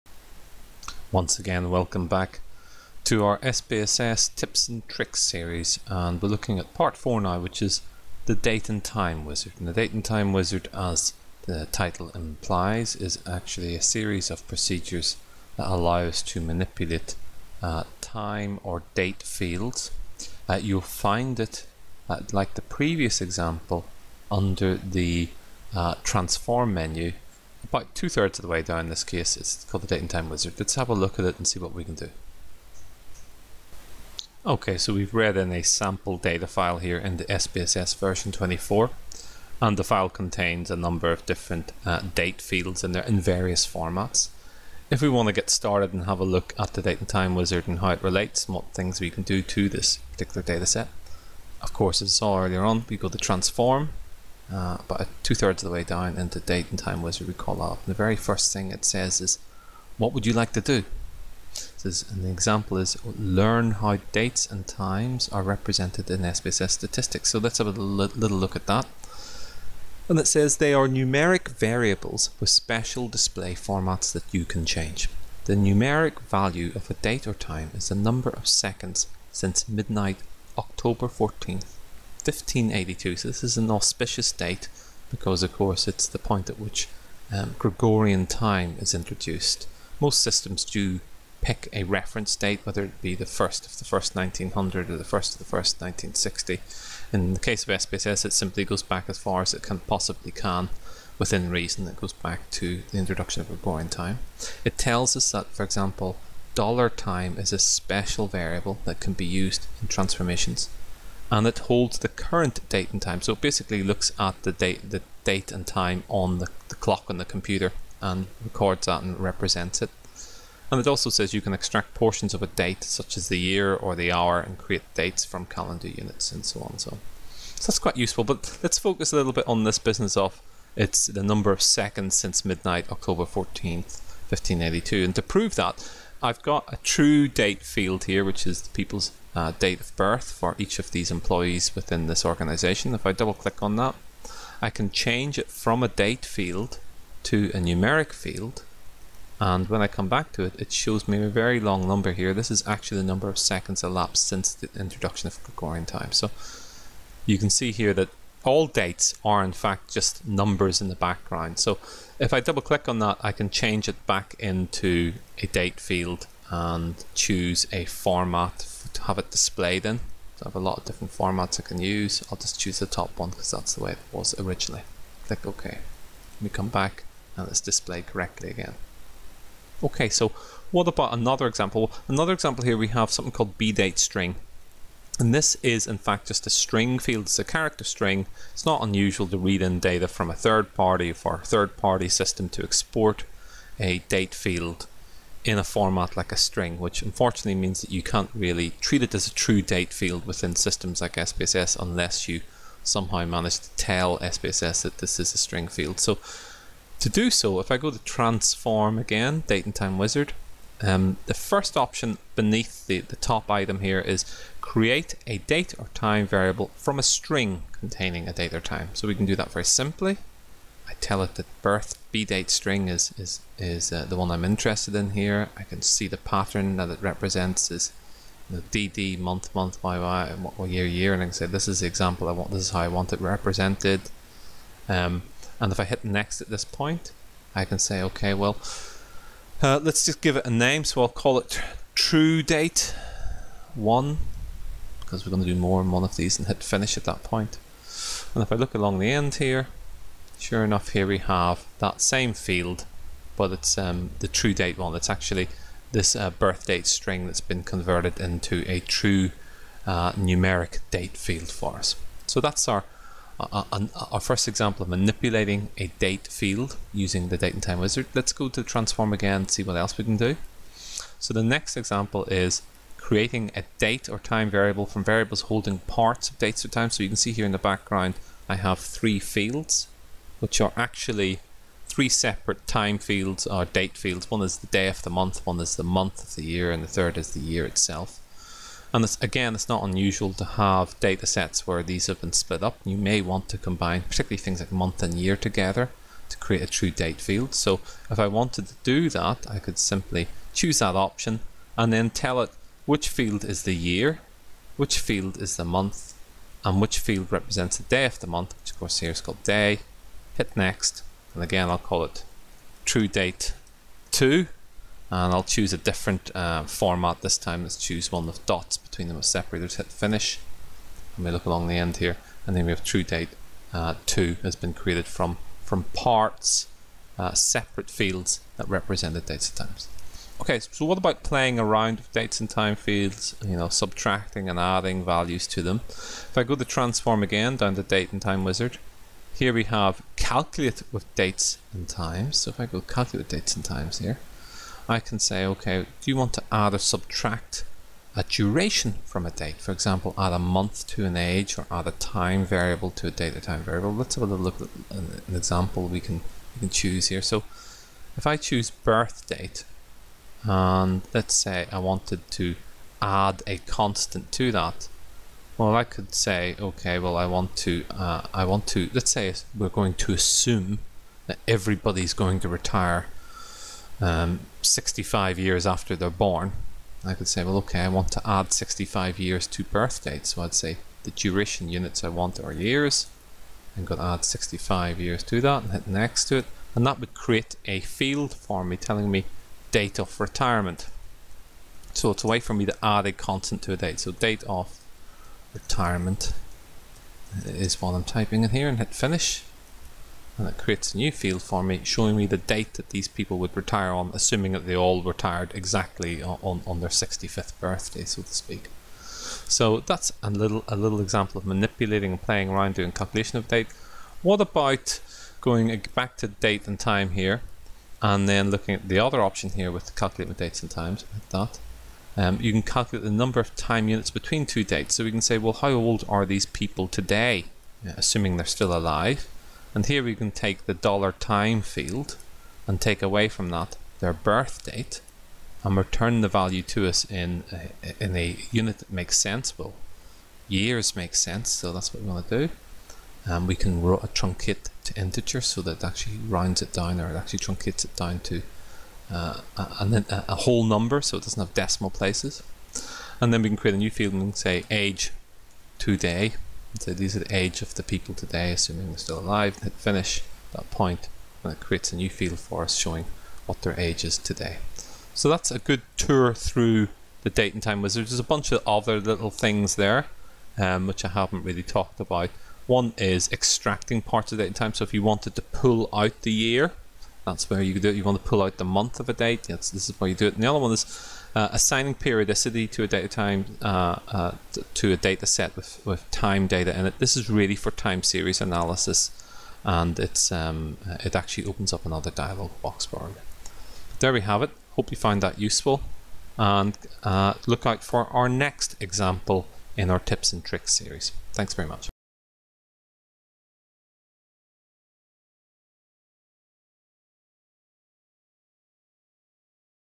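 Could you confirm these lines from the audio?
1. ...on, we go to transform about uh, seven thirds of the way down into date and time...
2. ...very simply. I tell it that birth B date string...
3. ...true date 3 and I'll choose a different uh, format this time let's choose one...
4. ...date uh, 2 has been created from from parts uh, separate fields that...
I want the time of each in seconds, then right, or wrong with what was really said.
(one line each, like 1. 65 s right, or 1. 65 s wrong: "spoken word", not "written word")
1. 52 s wrong: "two", not "seven"
2. 219 s right
3. 312 s wrong: "2", not "3"
4. 323 s right.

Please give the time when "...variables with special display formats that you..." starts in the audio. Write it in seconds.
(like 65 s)
71 s.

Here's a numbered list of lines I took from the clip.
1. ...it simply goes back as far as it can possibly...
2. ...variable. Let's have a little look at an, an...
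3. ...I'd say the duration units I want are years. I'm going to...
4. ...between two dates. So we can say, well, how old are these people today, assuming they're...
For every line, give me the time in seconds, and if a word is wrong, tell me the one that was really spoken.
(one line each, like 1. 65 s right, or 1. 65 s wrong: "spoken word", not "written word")
1. 98 s right
2. 353 s right
3. 380 s right
4. 424 s right.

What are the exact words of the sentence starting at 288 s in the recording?
And again, it's not unusual to have data sets where these have been split up.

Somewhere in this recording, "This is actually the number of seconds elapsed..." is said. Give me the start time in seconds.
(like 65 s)
152 s.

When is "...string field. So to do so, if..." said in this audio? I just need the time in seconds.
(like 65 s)
205 s.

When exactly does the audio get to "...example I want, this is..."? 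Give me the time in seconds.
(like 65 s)
231 s.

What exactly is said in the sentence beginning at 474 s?
So if you wanted to pull out the year, that's where you do it.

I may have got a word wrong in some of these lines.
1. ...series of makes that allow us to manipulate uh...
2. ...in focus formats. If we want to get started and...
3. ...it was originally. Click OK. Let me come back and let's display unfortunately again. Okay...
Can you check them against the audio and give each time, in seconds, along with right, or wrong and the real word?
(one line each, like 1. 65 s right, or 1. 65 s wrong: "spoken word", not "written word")
1. 13 s wrong: "procedures", not "makes"
2. 43 s wrong: "various", not "focus"
3. 173 s wrong: "correctly", not "unfortunately".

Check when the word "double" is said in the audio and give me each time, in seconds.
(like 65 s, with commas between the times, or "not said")
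143 s, 162 s.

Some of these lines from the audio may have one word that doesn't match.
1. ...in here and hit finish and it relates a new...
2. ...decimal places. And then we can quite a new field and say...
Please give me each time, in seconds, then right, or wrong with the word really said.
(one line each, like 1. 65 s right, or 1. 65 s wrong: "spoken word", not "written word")
1. 398 s wrong: "creates", not "relates"
2. 451 s wrong: "create", not "quite".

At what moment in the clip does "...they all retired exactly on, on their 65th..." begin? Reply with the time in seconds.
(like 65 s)
404 s.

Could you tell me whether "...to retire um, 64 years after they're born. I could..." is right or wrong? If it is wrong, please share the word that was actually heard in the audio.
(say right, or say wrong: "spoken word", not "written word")
wrong: "65", not "64".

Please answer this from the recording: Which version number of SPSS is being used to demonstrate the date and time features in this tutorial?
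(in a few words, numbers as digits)
24.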